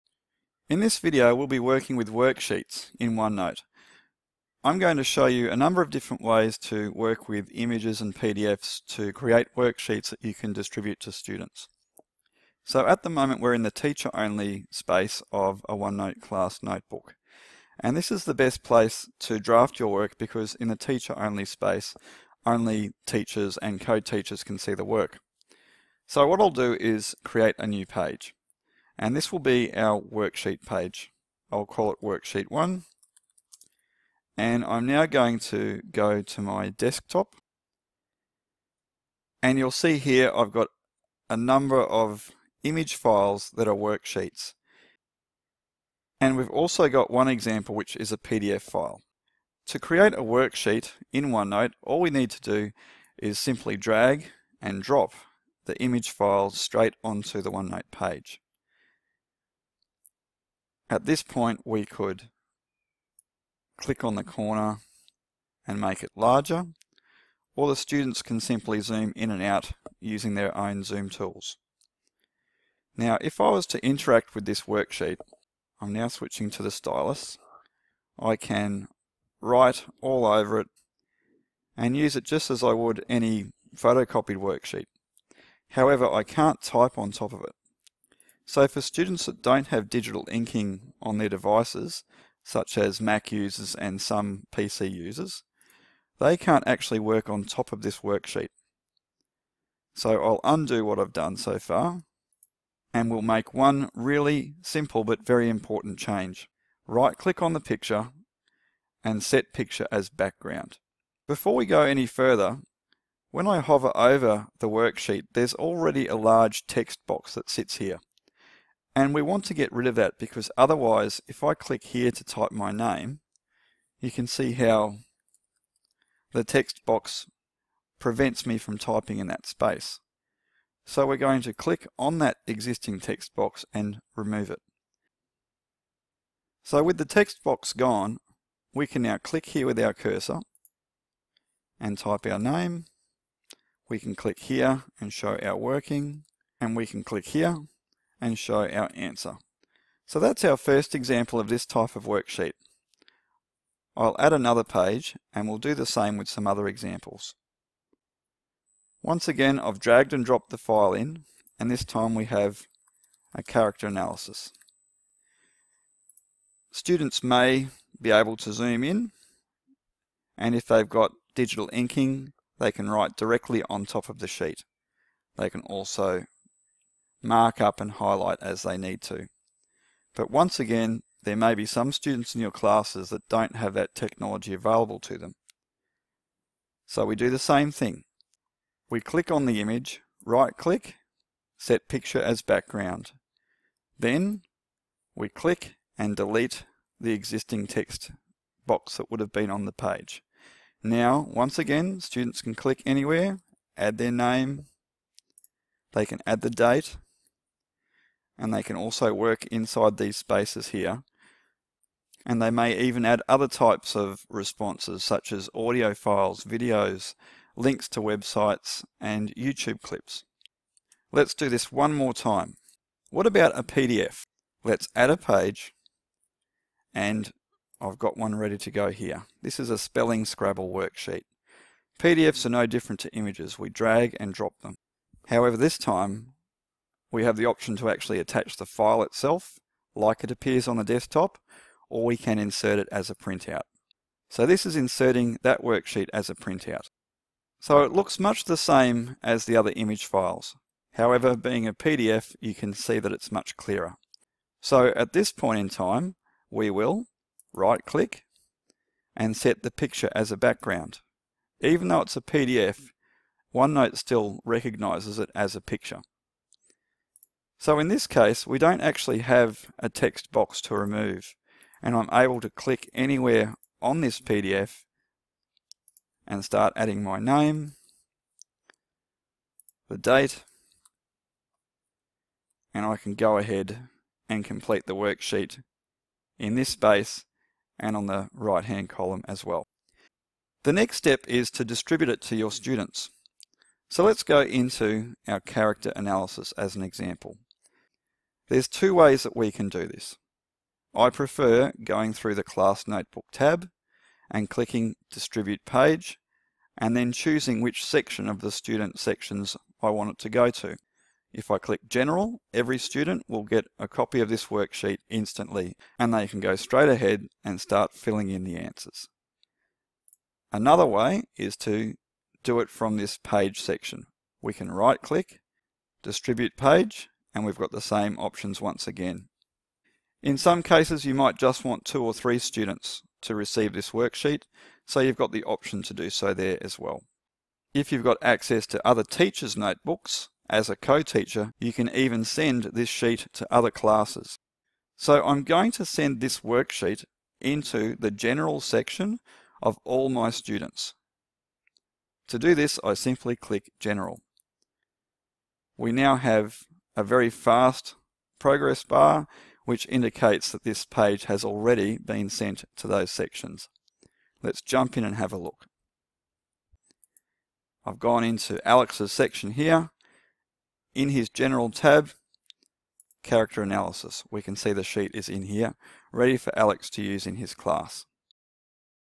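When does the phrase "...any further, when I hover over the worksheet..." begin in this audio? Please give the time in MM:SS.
01:51.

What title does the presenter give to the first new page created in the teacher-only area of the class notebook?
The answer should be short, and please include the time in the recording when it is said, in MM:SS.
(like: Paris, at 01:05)
Worksheet 1, at 00:32.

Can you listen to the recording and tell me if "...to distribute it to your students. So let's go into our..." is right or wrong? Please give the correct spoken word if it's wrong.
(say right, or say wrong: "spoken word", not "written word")
right.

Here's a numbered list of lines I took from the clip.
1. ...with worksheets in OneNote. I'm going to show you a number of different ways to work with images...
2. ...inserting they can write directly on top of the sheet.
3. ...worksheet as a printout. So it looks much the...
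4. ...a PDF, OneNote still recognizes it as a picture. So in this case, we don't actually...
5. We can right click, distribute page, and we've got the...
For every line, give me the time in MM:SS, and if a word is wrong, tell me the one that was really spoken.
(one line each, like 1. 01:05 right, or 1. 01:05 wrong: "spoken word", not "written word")
1. 00:01 right
2. 02:51 wrong: "inking", not "inserting"
3. 04:05 right
4. 04:22 right
5. 05:24 right.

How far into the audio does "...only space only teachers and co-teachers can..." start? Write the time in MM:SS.
00:21.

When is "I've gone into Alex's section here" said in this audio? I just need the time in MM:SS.
06:07.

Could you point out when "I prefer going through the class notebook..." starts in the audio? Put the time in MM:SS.
05:00.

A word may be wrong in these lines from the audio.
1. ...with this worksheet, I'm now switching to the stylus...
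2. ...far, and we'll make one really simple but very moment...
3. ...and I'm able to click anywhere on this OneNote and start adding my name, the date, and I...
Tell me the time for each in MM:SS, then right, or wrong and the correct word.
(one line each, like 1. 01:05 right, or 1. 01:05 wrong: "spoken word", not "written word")
1. 01:14 right
2. 01:41 wrong: "important", not "moment"
3. 04:31 wrong: "PDF", not "OneNote".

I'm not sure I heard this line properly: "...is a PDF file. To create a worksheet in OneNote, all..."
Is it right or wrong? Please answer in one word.
right.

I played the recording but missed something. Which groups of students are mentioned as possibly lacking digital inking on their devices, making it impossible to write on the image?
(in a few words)
Mac users and some PC users.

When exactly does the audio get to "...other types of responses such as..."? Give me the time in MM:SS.
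03:33.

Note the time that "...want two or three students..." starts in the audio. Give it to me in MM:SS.
05:31.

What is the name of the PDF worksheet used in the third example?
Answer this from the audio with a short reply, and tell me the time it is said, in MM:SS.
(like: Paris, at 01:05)
Spelling Scrabble worksheet, at 03:49.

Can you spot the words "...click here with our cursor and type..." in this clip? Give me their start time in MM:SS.
02:19.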